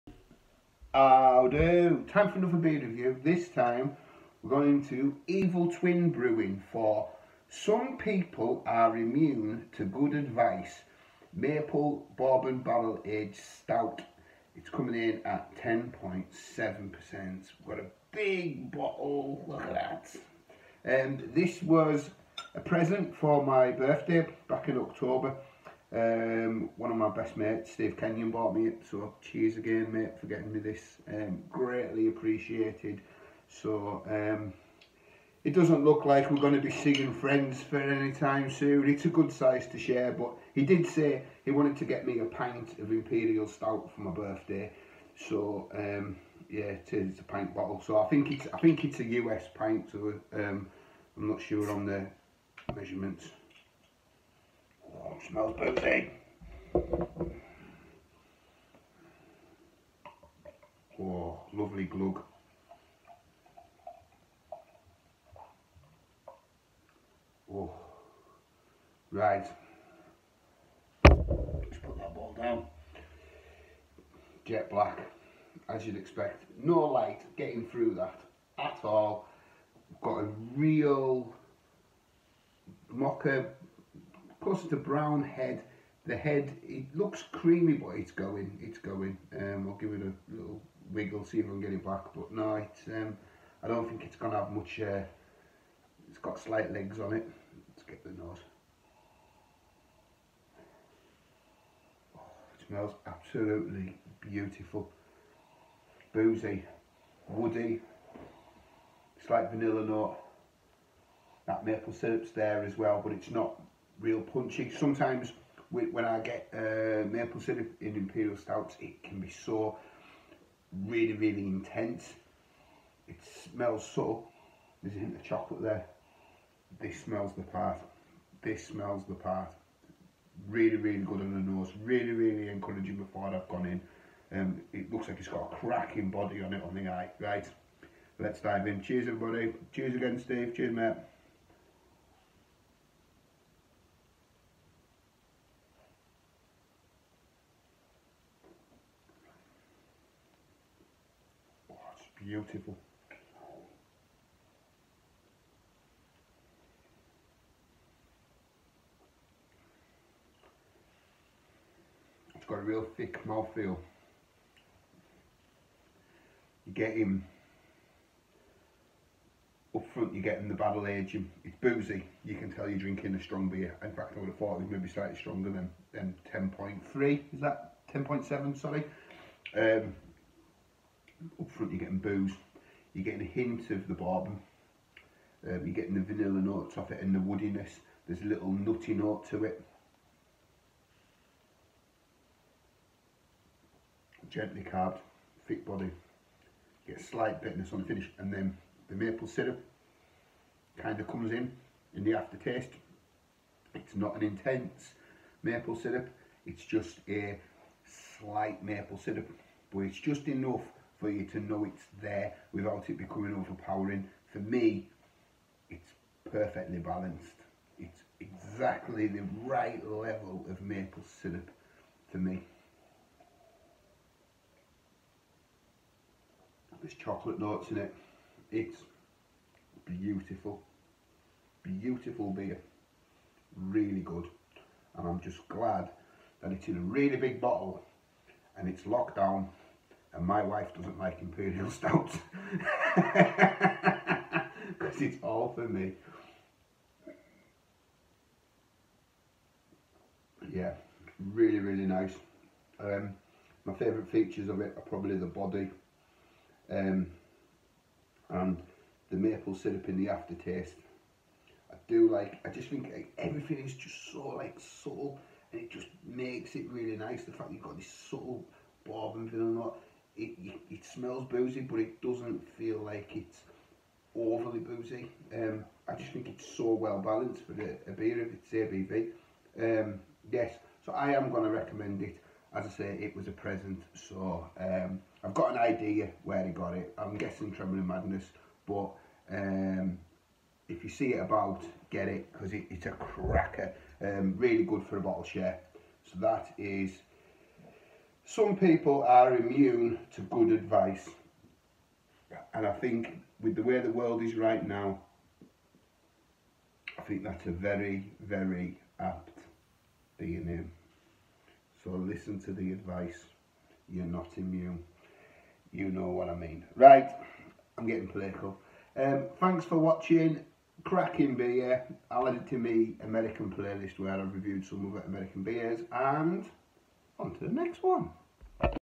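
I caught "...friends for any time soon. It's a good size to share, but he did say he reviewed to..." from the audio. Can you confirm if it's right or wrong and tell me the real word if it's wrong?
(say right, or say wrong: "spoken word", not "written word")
wrong: "wanted", not "reviewed".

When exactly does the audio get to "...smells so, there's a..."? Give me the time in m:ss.
2:03.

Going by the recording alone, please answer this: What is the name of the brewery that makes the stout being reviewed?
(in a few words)
Evil Twin Brewing.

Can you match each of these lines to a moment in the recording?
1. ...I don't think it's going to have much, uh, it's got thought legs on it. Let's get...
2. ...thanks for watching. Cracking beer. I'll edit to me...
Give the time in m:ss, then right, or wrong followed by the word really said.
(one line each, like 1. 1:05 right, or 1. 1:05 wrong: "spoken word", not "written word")
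1. 1:33 wrong: "slight", not "thought"
2. 5:19 right.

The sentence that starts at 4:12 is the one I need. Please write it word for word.
Um, my favourite features of it are probably the body um, and the maple syrup in the aftertaste.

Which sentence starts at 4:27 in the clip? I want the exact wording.
The fact you've got this subtle bourbon feeling and it, it smells boozy, but it doesn't feel like it's overly boozy.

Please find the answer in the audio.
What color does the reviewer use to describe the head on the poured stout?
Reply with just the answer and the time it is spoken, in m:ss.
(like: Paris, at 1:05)
Mocha, at 1:22.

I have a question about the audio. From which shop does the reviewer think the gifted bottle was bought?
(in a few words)
Trembling Madness.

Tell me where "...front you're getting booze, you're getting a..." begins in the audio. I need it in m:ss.
3:01.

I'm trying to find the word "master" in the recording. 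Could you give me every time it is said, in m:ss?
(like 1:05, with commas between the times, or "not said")
not said.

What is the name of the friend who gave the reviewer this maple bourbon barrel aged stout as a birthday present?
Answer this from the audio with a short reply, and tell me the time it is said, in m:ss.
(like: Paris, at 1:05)
Steve Kenyon, at 0:27.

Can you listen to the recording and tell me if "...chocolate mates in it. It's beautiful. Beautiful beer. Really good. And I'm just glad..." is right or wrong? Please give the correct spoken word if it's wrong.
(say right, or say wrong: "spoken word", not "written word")
wrong: "notes", not "mates".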